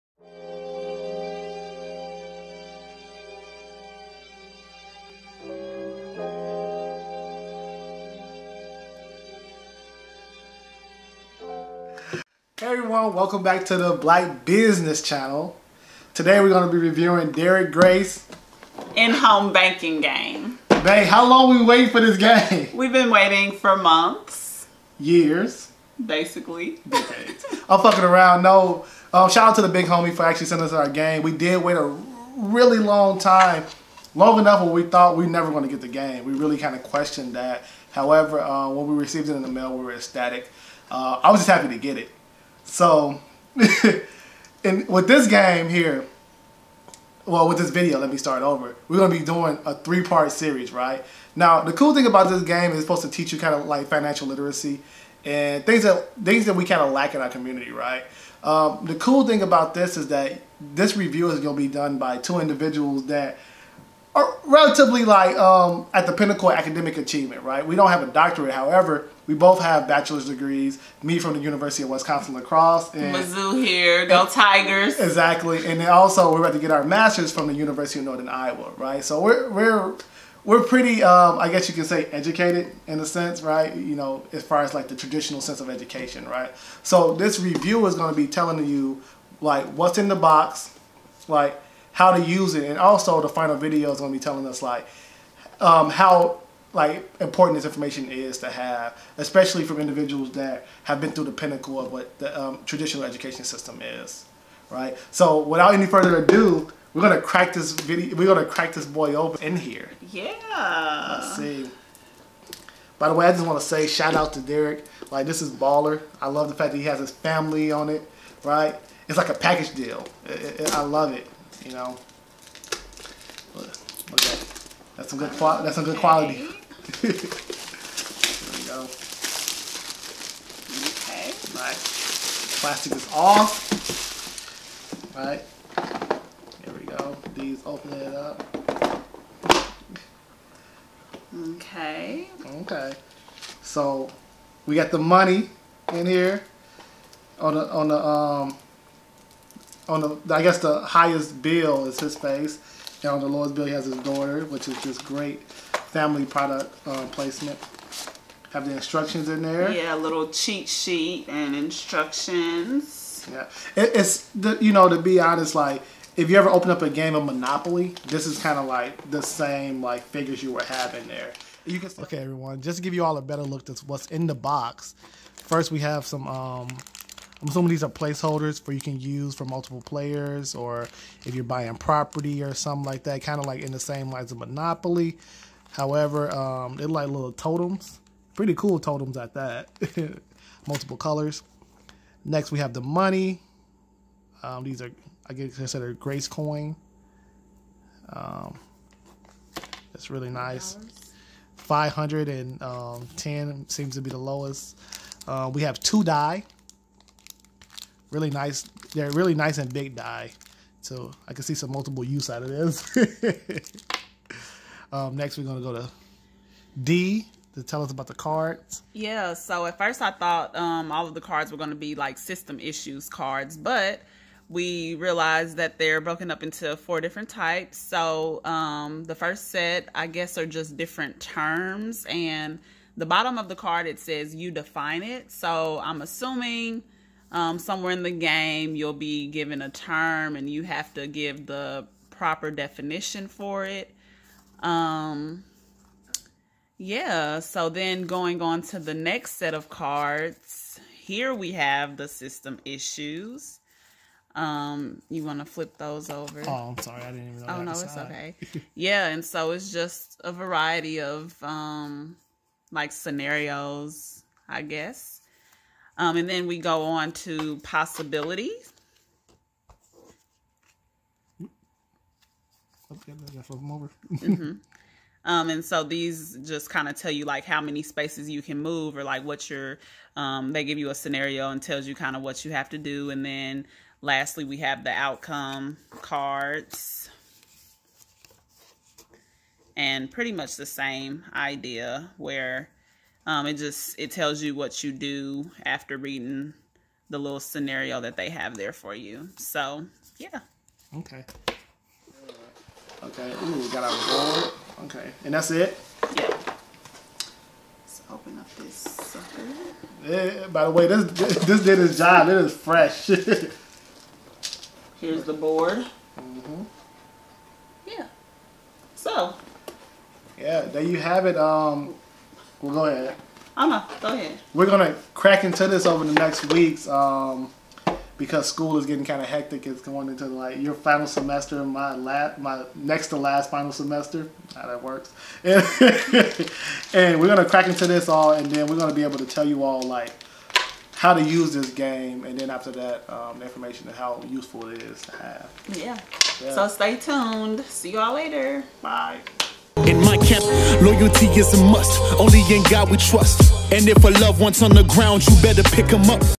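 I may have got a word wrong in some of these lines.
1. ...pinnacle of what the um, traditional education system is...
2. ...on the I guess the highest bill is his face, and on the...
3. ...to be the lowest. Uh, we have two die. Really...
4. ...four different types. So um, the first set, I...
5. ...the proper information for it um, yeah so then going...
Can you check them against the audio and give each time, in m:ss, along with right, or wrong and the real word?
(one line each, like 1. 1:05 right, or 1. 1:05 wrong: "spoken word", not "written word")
1. 1:41 right
2. 2:29 right
3. 3:23 right
4. 3:46 right
5. 4:01 wrong: "definition", not "information".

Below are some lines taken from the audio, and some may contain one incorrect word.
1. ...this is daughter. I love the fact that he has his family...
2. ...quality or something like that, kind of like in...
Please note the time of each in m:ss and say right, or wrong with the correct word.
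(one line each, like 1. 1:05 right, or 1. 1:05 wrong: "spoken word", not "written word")
1. 1:55 wrong: "baller", not "daughter"
2. 3:01 wrong: "property", not "quality".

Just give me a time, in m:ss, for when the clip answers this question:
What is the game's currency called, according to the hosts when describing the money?
3:15.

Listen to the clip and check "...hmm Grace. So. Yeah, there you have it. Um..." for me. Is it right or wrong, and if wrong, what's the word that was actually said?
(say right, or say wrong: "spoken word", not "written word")
wrong: "Yeah", not "Grace".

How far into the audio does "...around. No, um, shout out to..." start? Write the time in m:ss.
0:28.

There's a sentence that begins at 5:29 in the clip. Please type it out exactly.
It's going into like your final semester, my la- my next to last final semester.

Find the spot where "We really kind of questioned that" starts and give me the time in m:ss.
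0:36.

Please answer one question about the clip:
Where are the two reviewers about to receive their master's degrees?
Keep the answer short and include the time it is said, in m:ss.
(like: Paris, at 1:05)
University of Northern Iowa, at 1:17.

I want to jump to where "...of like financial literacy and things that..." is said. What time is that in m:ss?
0:53.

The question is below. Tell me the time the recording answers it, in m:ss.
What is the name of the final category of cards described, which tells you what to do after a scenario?
4:45.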